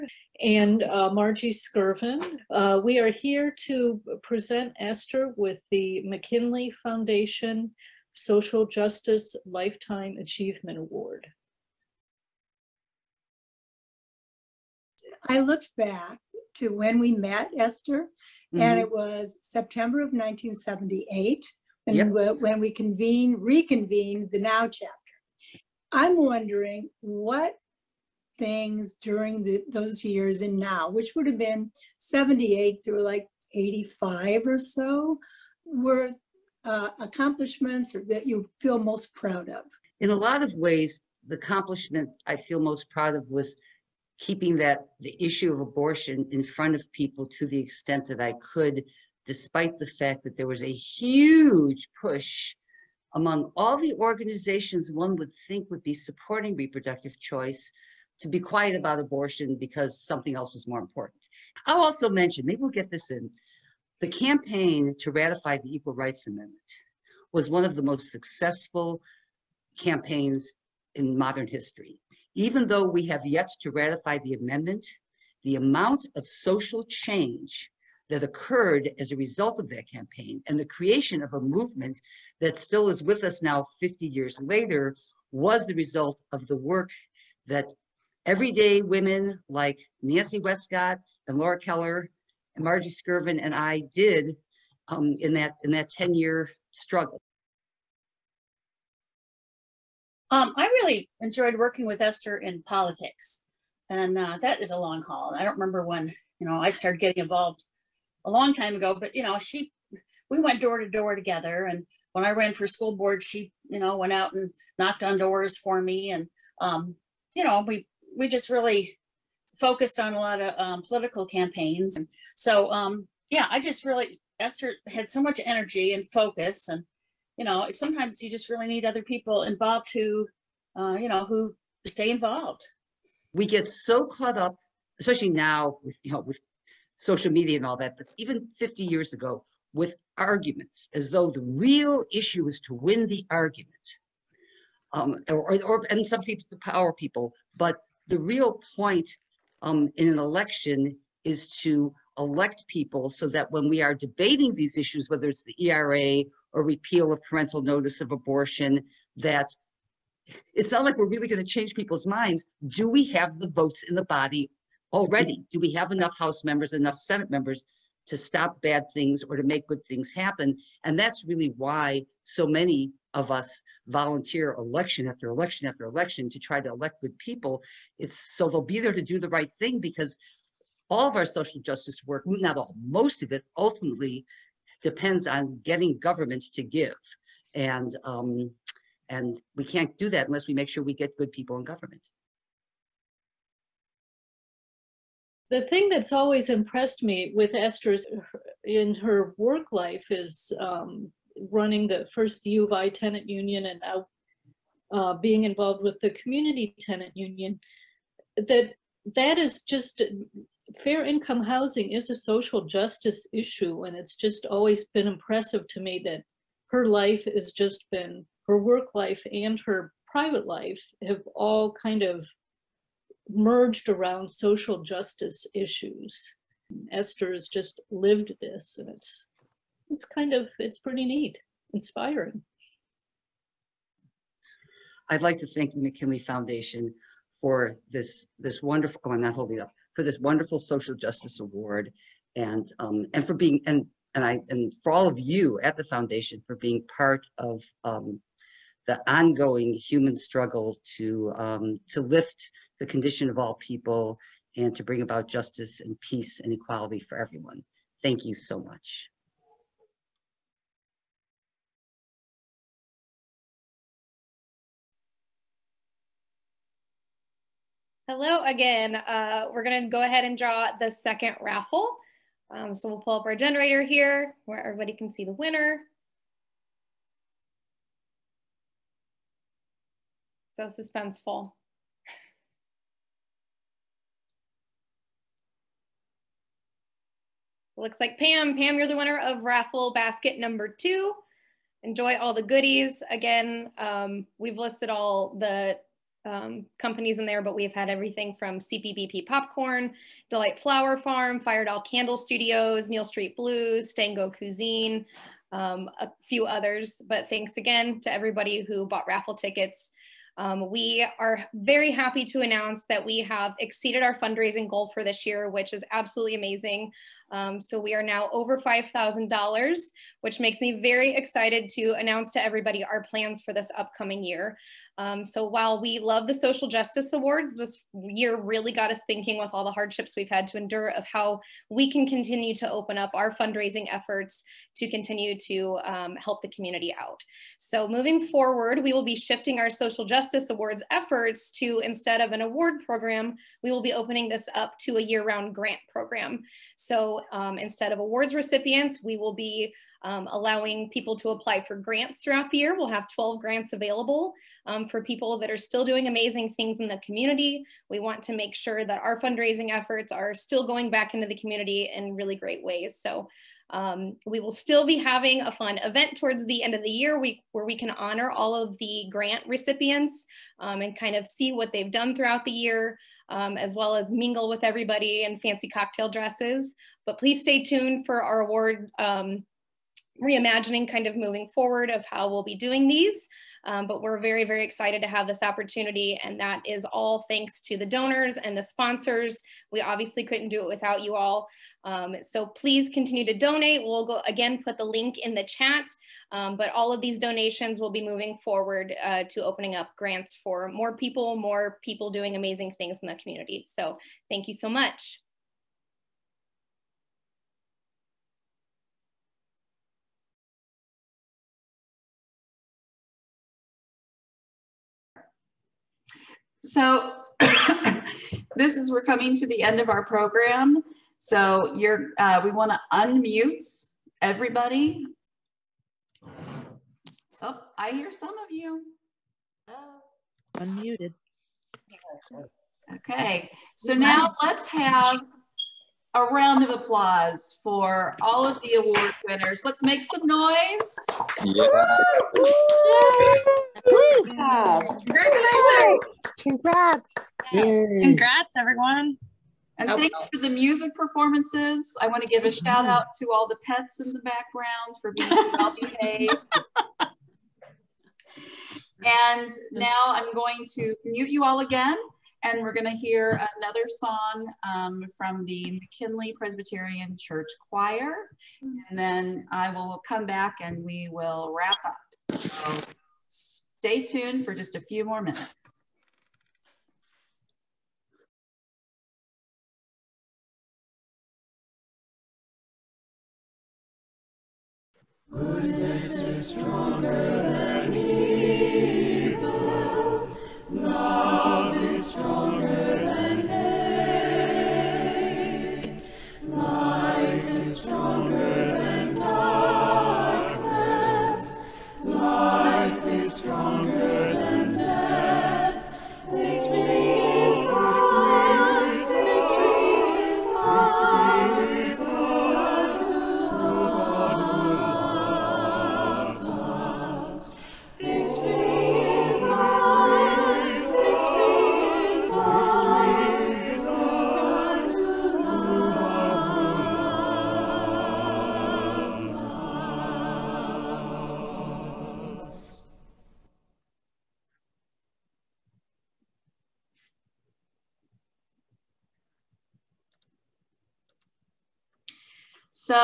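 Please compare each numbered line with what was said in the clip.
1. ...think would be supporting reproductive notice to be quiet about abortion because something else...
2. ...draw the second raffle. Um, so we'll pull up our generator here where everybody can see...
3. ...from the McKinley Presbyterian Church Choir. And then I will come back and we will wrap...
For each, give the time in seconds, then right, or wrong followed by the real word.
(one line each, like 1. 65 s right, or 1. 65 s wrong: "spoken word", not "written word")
1. 55 s wrong: "choice", not "notice"
2. 270 s right
3. 465 s right.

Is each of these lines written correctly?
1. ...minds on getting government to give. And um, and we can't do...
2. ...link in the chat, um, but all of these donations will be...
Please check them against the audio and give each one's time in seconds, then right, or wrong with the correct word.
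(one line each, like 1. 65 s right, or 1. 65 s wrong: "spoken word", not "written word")
1. 184 s wrong: "depends", not "minds"
2. 394 s right.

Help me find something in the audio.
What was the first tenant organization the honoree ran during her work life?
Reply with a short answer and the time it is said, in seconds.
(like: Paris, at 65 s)
U of I tenant union, at 202 s.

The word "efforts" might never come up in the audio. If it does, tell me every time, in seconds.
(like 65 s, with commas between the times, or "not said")
333 s, 340 s, 359 s.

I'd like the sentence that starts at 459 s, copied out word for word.
and now I'm going to mute you all again.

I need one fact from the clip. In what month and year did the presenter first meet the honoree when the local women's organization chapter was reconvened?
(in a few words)
September 1978.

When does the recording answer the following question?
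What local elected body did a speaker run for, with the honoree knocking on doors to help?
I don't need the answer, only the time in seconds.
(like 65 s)
112 s.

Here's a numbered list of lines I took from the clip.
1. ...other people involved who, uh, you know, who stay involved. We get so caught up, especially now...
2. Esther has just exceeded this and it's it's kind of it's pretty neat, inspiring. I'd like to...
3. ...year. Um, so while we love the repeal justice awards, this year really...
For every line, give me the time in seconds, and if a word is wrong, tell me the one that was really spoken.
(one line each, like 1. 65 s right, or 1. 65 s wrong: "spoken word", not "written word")
1. 128 s right
2. 226 s wrong: "lived", not "exceeded"
3. 324 s wrong: "social", not "repeal".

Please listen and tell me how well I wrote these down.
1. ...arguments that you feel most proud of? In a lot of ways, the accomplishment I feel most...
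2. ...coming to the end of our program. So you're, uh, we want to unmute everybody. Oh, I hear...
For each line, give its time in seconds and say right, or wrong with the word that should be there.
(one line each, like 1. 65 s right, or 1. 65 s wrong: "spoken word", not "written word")
1. 36 s wrong: "accomplishments", not "arguments"
2. 419 s right.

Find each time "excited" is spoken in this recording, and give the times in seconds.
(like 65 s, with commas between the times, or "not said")
321 s, 384 s.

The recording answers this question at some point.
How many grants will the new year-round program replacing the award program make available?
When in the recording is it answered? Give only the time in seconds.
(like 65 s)
353 s.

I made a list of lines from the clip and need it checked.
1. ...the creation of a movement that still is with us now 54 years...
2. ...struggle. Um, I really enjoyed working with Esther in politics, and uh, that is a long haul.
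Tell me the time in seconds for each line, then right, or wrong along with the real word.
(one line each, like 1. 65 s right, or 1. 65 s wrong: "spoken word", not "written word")
1. 80 s wrong: "50", not "54"
2. 96 s right.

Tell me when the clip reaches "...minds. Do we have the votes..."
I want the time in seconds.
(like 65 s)
162 s.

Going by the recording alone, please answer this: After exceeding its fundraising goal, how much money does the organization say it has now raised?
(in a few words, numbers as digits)
$5,000.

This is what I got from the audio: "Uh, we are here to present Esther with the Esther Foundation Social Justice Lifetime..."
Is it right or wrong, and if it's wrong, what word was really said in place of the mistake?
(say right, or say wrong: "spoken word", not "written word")
wrong: "McKinley", not "Esther".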